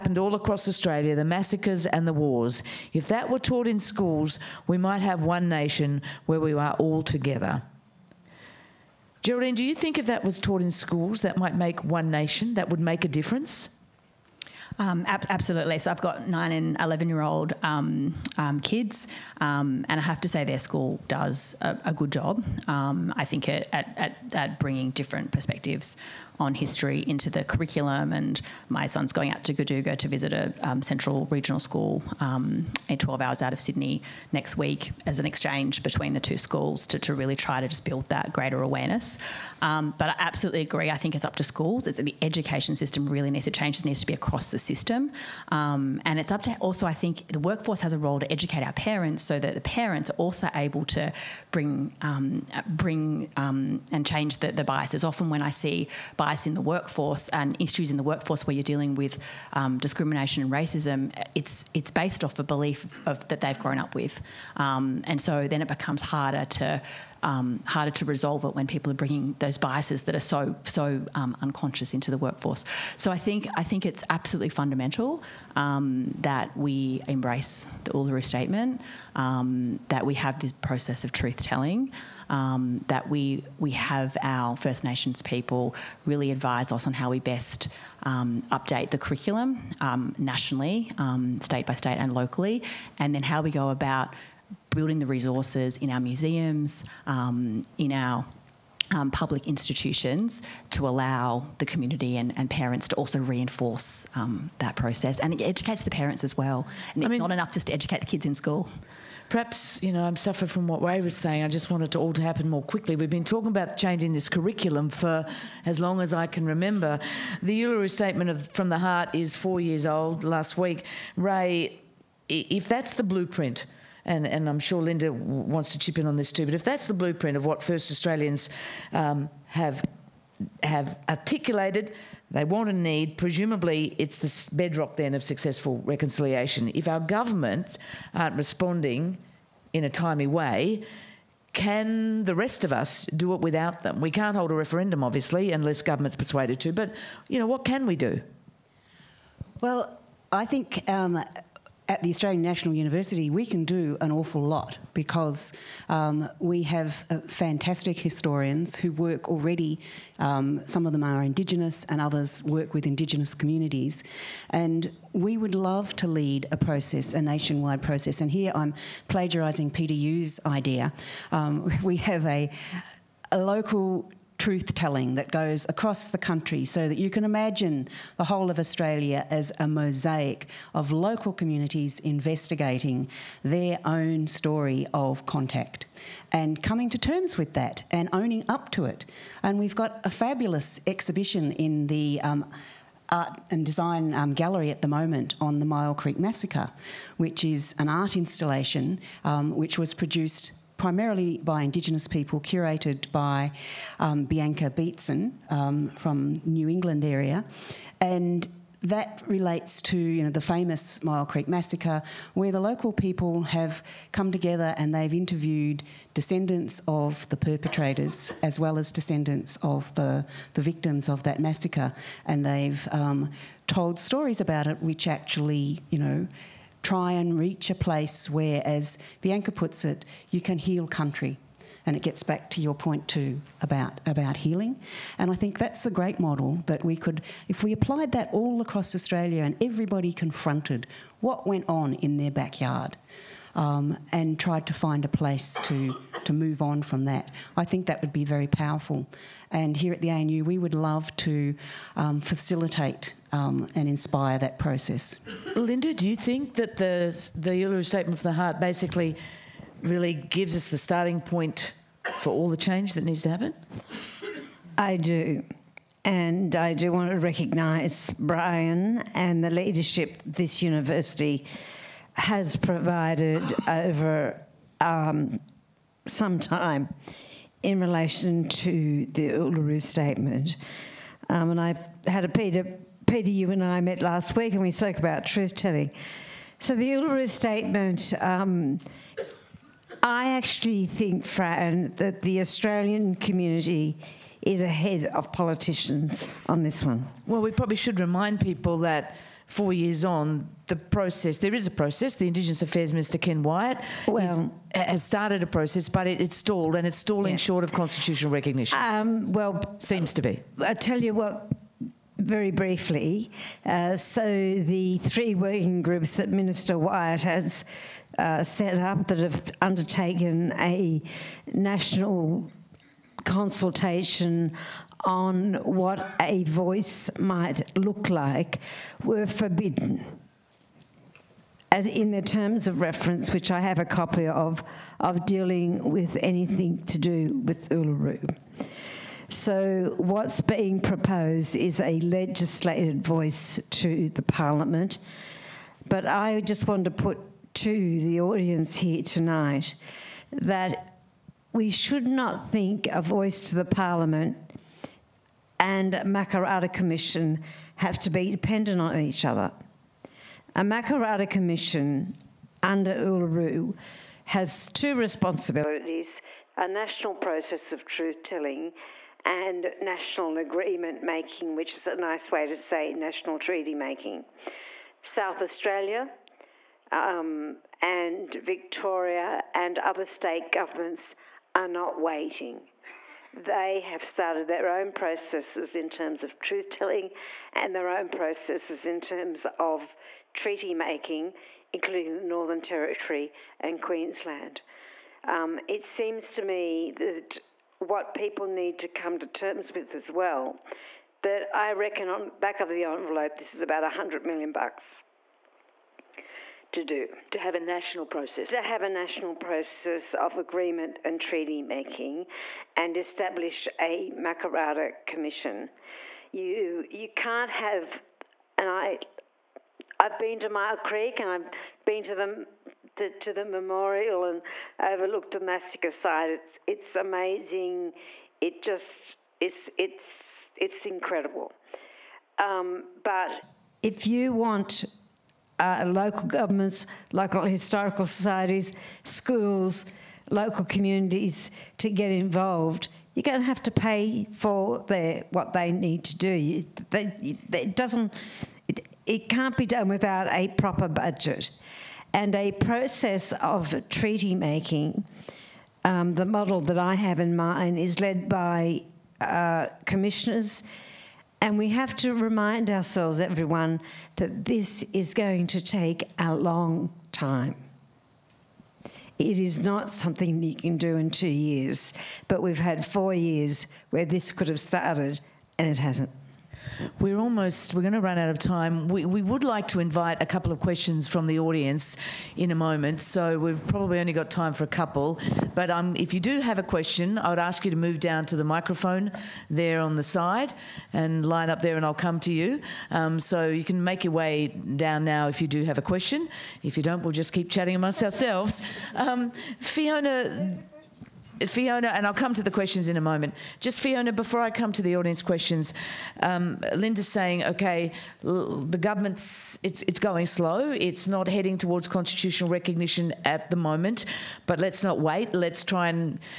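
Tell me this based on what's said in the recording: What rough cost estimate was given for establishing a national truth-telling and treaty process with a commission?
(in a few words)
100 million dollars.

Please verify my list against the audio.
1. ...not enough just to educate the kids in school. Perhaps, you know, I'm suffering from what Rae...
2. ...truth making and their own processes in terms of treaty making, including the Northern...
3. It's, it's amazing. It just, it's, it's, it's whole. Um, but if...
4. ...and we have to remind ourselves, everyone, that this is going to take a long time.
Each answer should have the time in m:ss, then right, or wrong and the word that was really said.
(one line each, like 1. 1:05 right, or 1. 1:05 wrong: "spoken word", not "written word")
1. 1:47 right
2. 6:26 wrong: "telling", not "making"
3. 7:06 wrong: "incredible", not "whole"
4. 7:41 right.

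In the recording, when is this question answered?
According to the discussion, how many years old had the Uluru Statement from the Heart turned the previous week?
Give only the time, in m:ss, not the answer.
1:59.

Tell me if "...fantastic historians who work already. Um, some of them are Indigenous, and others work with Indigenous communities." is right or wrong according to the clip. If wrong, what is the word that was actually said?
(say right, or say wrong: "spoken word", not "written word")
right.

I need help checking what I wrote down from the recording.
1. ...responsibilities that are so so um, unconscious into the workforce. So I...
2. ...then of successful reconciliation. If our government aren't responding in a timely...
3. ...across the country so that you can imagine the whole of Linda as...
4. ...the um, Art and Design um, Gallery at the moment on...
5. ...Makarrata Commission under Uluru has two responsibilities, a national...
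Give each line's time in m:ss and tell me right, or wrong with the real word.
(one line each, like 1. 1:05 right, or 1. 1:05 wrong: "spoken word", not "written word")
1. 1:09 wrong: "biases", not "responsibilities"
2. 2:14 right
3. 2:55 wrong: "Australia", not "Linda"
4. 3:11 right
5. 6:00 right.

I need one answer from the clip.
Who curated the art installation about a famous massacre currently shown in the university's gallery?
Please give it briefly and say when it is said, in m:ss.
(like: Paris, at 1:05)
Bianca Beetson, at 3:24.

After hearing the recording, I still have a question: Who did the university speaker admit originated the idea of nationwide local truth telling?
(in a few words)
Peter Yu.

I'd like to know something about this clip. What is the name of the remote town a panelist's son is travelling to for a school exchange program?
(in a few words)
Goodooga.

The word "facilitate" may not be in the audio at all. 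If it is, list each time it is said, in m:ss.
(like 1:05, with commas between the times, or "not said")
4:12.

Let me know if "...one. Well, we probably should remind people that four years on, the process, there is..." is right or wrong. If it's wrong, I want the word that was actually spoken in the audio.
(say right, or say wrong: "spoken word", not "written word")
right.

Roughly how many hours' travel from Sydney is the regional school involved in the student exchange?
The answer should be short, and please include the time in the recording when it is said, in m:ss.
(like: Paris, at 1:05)
12 hours, at 0:32.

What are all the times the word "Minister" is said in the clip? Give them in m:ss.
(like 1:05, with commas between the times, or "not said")
5:02, 5:16.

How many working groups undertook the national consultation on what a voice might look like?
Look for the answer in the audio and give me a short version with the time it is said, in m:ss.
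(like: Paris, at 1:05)
3, at 5:14.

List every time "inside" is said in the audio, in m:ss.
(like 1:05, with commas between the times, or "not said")
not said.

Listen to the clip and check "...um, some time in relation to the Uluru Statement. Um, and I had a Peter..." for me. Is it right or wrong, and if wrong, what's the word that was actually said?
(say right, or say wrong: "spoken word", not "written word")
right.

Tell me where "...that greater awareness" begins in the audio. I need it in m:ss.
0:38.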